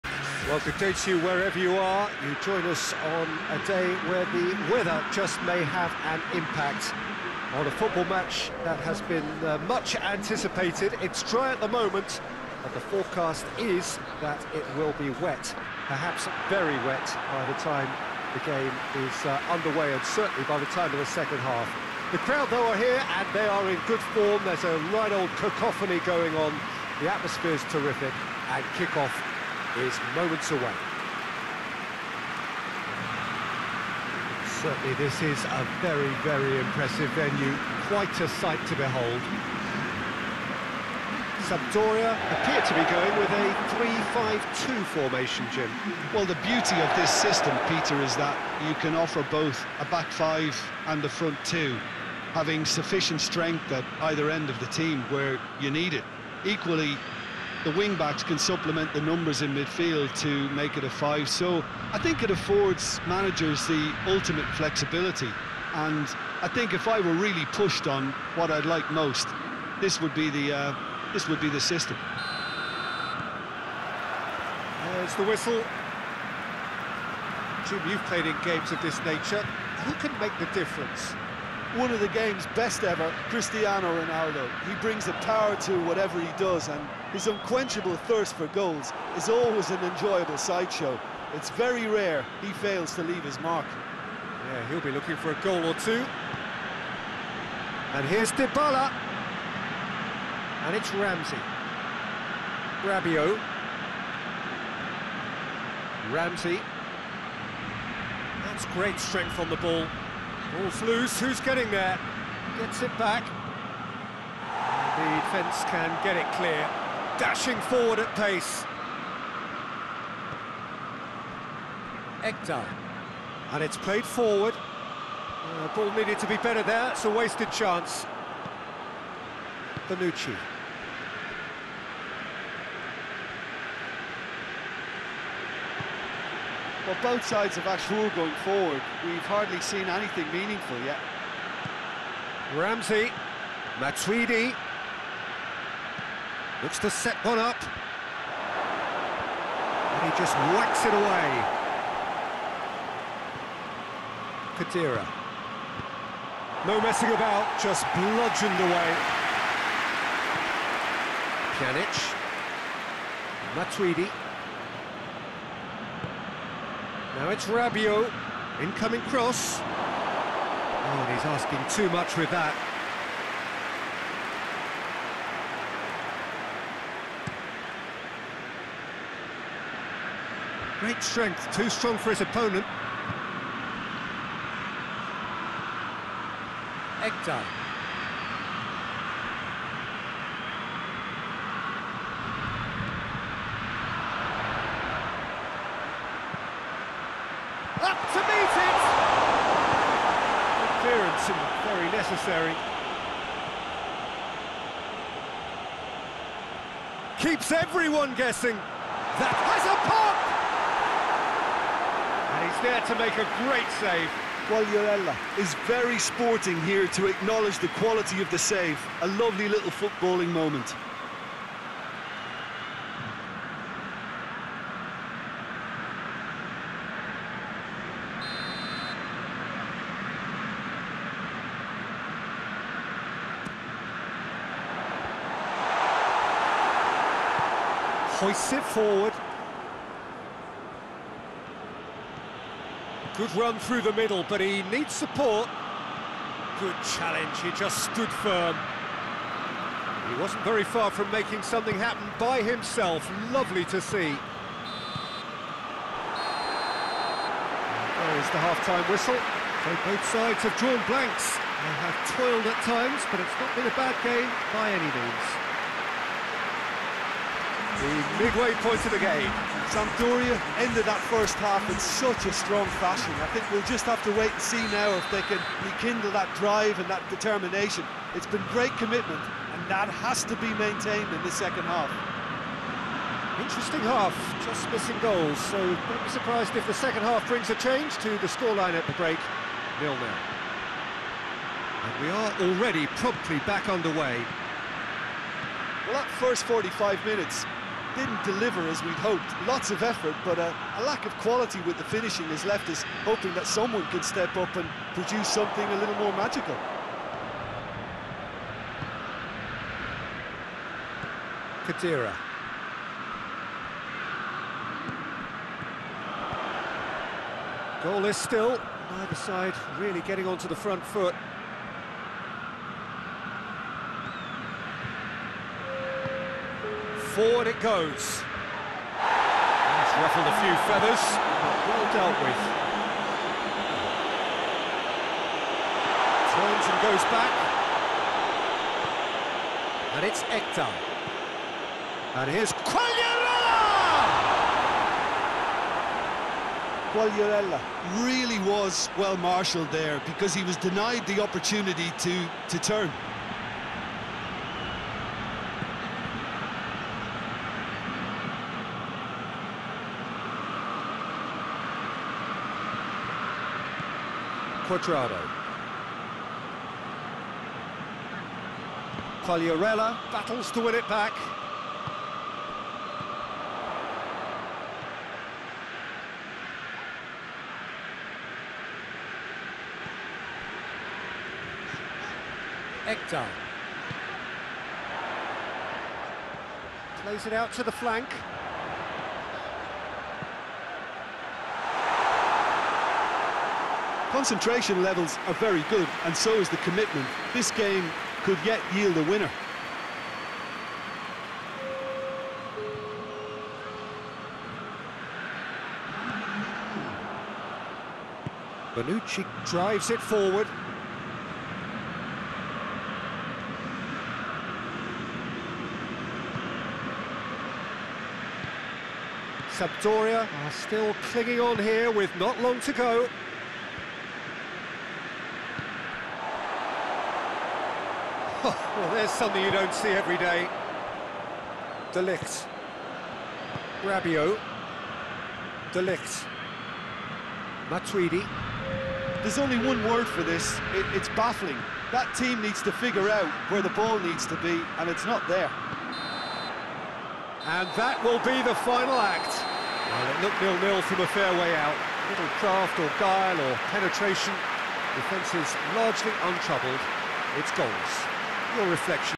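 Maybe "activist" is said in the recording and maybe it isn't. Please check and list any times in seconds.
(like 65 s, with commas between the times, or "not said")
not said.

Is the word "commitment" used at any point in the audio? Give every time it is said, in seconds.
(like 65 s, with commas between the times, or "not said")
278 s, 396 s.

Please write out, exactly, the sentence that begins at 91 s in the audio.
It's very rare he fails to leave his mark.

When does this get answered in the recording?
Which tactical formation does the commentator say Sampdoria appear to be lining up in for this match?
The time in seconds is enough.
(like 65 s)
43 s.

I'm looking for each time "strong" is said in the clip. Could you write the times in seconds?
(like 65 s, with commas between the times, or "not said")
181 s, 272 s.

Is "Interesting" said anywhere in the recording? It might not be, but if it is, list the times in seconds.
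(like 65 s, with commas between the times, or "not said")
283 s.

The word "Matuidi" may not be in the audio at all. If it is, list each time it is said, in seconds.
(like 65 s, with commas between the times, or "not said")
143 s, 163 s, 437 s.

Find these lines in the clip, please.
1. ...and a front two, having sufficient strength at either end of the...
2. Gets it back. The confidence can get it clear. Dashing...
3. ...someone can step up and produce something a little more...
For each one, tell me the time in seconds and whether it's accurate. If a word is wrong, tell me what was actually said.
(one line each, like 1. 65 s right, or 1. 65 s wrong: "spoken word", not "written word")
1. 50 s right
2. 112 s wrong: "defence", not "confidence"
3. 303 s right.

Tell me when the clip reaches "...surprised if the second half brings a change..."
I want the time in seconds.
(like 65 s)
286 s.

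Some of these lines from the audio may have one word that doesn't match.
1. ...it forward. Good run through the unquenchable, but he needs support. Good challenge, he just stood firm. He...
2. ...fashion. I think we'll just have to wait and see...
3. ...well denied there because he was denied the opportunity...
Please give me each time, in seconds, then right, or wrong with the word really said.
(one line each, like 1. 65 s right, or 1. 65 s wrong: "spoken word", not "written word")
1. 238 s wrong: "middle", not "unquenchable"
2. 272 s right
3. 348 s wrong: "marshalled", not "denied".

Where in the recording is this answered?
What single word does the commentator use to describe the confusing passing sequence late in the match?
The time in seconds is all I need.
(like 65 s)
441 s.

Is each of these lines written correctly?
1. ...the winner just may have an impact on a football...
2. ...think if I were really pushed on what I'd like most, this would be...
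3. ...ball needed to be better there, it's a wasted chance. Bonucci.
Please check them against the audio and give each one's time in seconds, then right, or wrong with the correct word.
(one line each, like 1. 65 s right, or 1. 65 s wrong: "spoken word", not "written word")
1. 4 s wrong: "weather", not "winner"
2. 66 s right
3. 125 s right.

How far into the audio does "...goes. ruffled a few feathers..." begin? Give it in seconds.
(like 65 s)
327 s.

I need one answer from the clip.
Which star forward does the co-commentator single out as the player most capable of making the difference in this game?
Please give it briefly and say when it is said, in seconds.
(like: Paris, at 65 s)
Cristiano Ronaldo, at 83 s.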